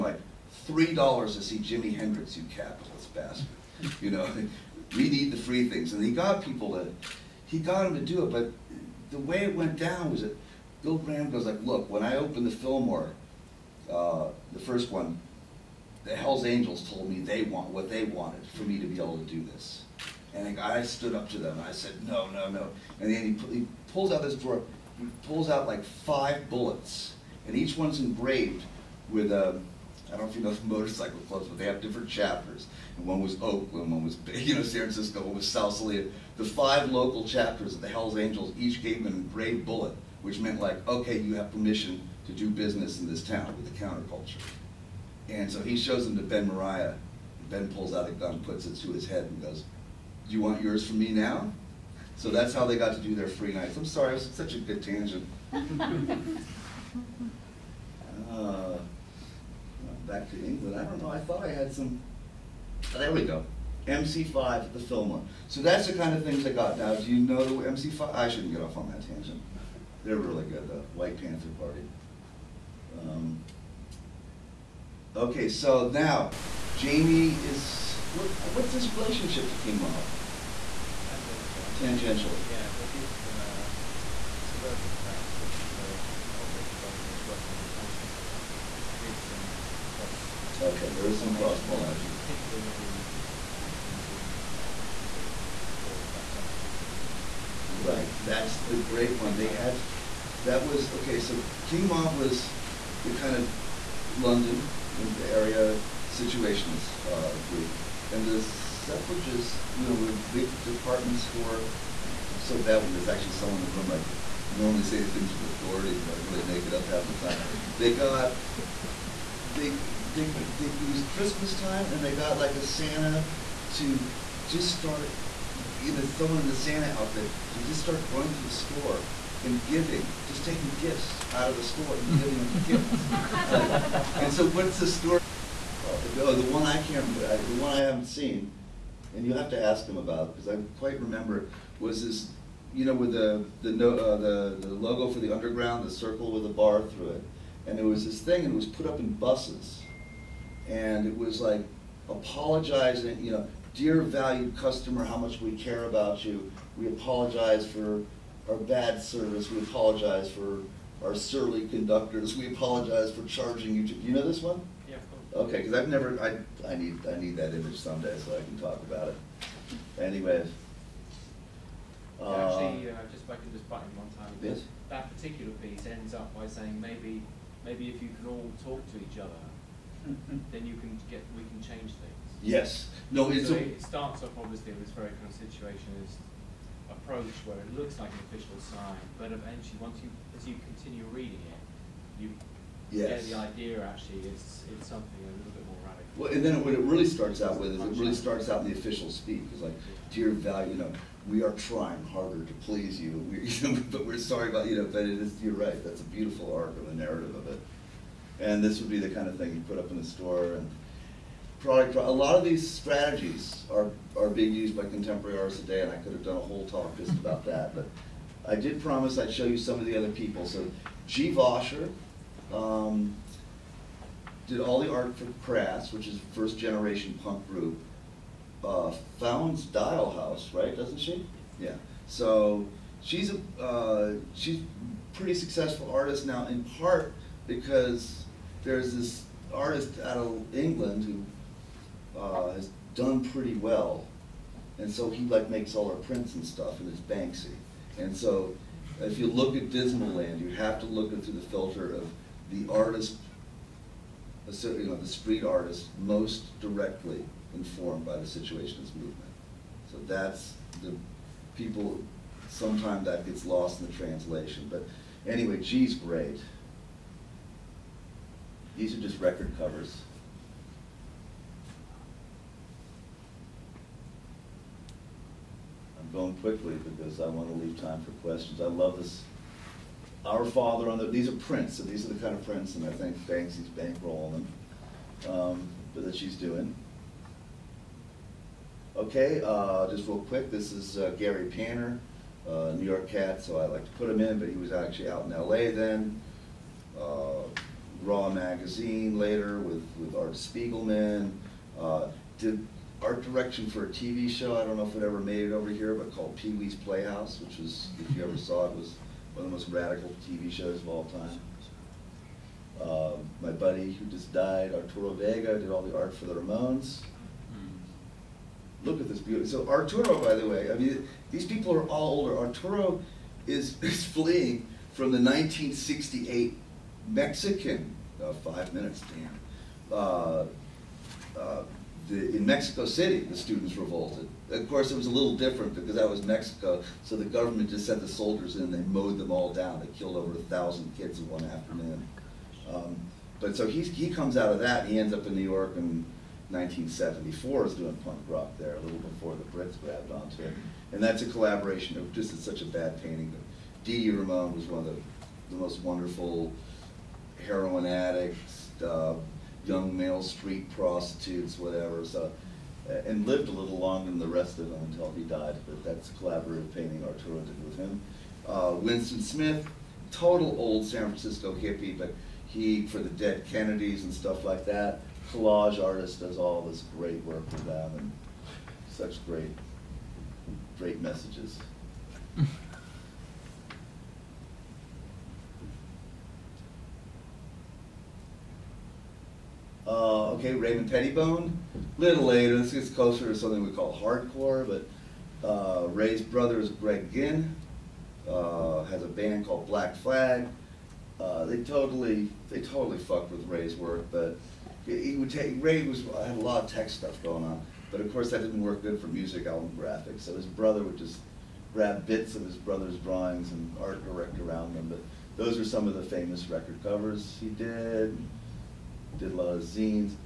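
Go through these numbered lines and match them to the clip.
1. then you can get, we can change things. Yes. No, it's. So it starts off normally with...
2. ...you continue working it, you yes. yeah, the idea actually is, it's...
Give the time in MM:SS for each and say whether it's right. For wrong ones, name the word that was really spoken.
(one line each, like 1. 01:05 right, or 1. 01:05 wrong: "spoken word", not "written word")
1. 03:00 wrong: "obviously", not "normally"
2. 03:10 wrong: "reading", not "working".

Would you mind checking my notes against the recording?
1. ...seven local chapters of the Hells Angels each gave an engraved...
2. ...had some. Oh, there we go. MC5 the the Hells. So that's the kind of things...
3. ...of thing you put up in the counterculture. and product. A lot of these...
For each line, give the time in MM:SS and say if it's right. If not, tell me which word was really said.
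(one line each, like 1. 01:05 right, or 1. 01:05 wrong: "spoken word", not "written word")
1. 00:36 wrong: "five", not "seven"
2. 01:01 wrong: "Fillmore", not "Hells"
3. 03:29 wrong: "store", not "counterculture".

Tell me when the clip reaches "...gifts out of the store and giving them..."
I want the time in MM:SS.
02:10.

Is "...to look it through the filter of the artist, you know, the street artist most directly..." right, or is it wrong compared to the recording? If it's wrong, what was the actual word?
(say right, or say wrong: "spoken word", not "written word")
right.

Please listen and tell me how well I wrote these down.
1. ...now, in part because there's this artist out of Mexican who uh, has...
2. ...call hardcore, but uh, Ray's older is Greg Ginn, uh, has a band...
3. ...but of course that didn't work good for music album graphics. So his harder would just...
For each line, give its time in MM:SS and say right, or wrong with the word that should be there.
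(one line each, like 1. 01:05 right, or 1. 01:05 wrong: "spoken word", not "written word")
1. 03:56 wrong: "England", not "Mexican"
2. 06:33 wrong: "brother", not "older"
3. 06:47 wrong: "brother", not "harder".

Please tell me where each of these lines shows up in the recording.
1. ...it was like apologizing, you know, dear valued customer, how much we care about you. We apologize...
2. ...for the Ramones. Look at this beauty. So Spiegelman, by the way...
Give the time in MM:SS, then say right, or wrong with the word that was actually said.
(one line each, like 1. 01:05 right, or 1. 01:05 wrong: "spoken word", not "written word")
1. 02:31 right
2. 05:16 wrong: "Arturo", not "Spiegelman".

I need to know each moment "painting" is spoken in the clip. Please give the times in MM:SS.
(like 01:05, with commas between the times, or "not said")
05:53, 06:06.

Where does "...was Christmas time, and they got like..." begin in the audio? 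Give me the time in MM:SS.
02:00.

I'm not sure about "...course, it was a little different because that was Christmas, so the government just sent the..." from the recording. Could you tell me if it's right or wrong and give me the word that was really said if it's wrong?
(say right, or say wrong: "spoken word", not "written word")
wrong: "Mexico", not "Christmas".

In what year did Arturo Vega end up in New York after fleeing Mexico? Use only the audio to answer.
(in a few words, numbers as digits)
1974.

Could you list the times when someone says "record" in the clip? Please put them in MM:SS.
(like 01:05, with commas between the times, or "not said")
04:29, 06:56.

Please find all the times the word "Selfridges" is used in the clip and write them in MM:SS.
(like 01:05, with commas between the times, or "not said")
01:36, 01:48.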